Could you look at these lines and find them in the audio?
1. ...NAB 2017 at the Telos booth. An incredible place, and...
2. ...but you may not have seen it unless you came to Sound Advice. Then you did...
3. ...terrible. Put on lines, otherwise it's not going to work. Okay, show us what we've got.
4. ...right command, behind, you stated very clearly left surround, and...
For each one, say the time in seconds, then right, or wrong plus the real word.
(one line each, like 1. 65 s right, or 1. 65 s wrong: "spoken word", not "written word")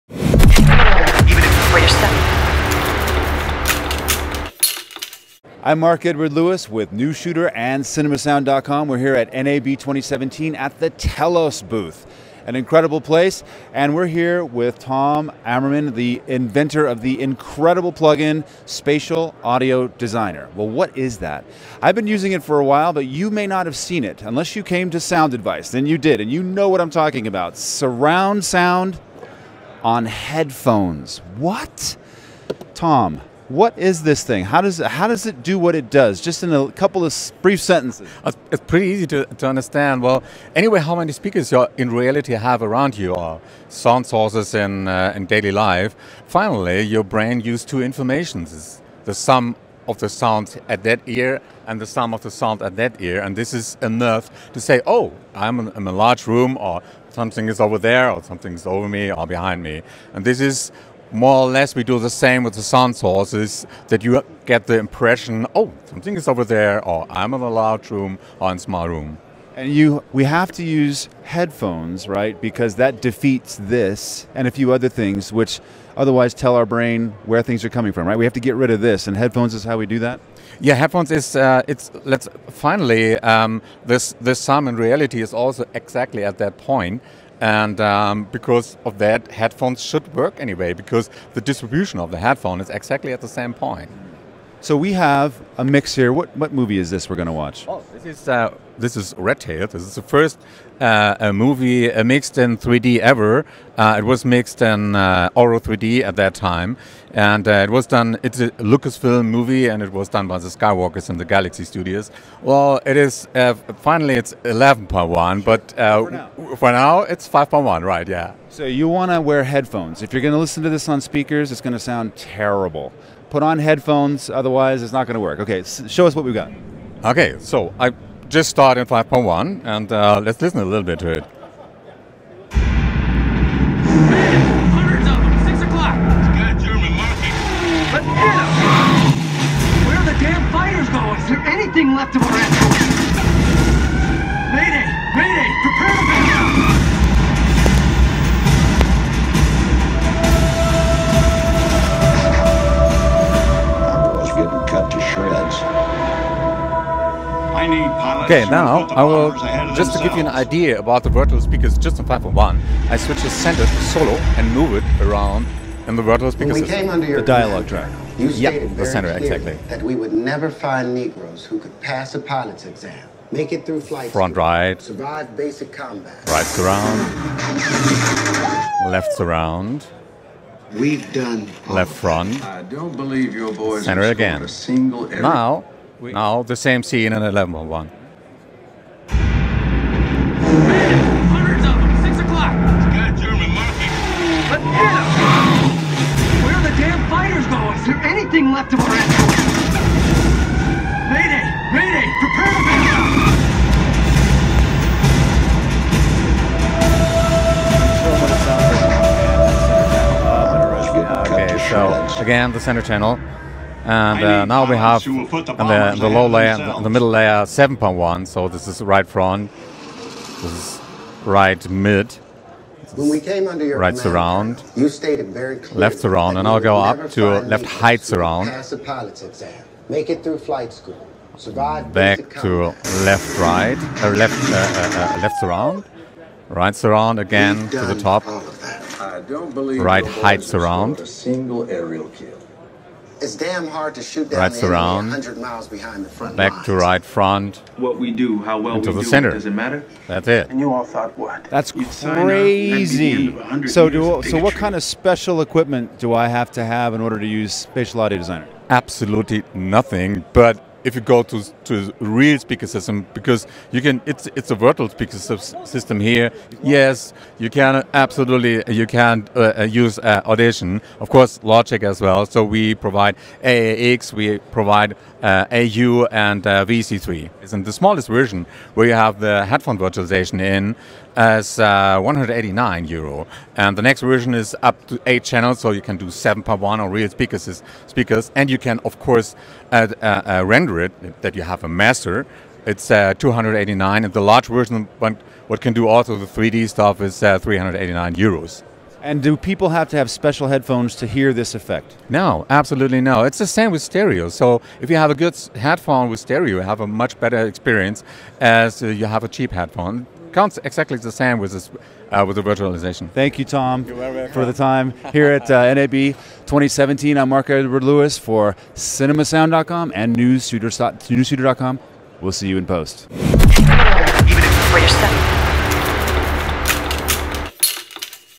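1. 9 s right
2. 22 s right
3. 122 s wrong: "headphones", not "lines"
4. 223 s wrong: "surround", not "behind".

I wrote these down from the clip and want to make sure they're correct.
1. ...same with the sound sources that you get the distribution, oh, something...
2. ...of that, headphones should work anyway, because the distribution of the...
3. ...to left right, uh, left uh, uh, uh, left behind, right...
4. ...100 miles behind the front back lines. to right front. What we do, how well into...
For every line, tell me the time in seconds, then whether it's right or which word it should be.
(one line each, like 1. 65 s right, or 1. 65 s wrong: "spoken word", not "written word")
1. 62 s wrong: "impression", not "distribution"
2. 88 s right
3. 232 s wrong: "surround", not "behind"
4. 245 s right.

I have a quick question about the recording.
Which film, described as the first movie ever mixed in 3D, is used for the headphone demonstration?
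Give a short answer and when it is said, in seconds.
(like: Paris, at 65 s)
Red Tail, at 99 s.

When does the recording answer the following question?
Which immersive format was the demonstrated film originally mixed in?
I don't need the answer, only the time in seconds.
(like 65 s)
105 s.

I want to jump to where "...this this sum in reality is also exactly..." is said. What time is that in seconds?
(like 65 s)
83 s.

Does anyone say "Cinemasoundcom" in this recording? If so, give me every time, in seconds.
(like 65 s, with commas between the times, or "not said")
7 s, 318 s.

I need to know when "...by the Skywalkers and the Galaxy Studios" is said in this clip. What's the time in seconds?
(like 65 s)
110 s.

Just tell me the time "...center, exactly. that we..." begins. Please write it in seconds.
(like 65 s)
168 s.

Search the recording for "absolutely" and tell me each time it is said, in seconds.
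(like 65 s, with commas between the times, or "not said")
258 s, 267 s, 302 s.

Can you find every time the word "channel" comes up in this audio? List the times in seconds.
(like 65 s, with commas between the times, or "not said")
212 s, 285 s.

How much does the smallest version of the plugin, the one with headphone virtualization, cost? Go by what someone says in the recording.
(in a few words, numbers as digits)
189 euros.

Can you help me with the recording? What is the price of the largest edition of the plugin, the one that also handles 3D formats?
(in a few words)
389 euros.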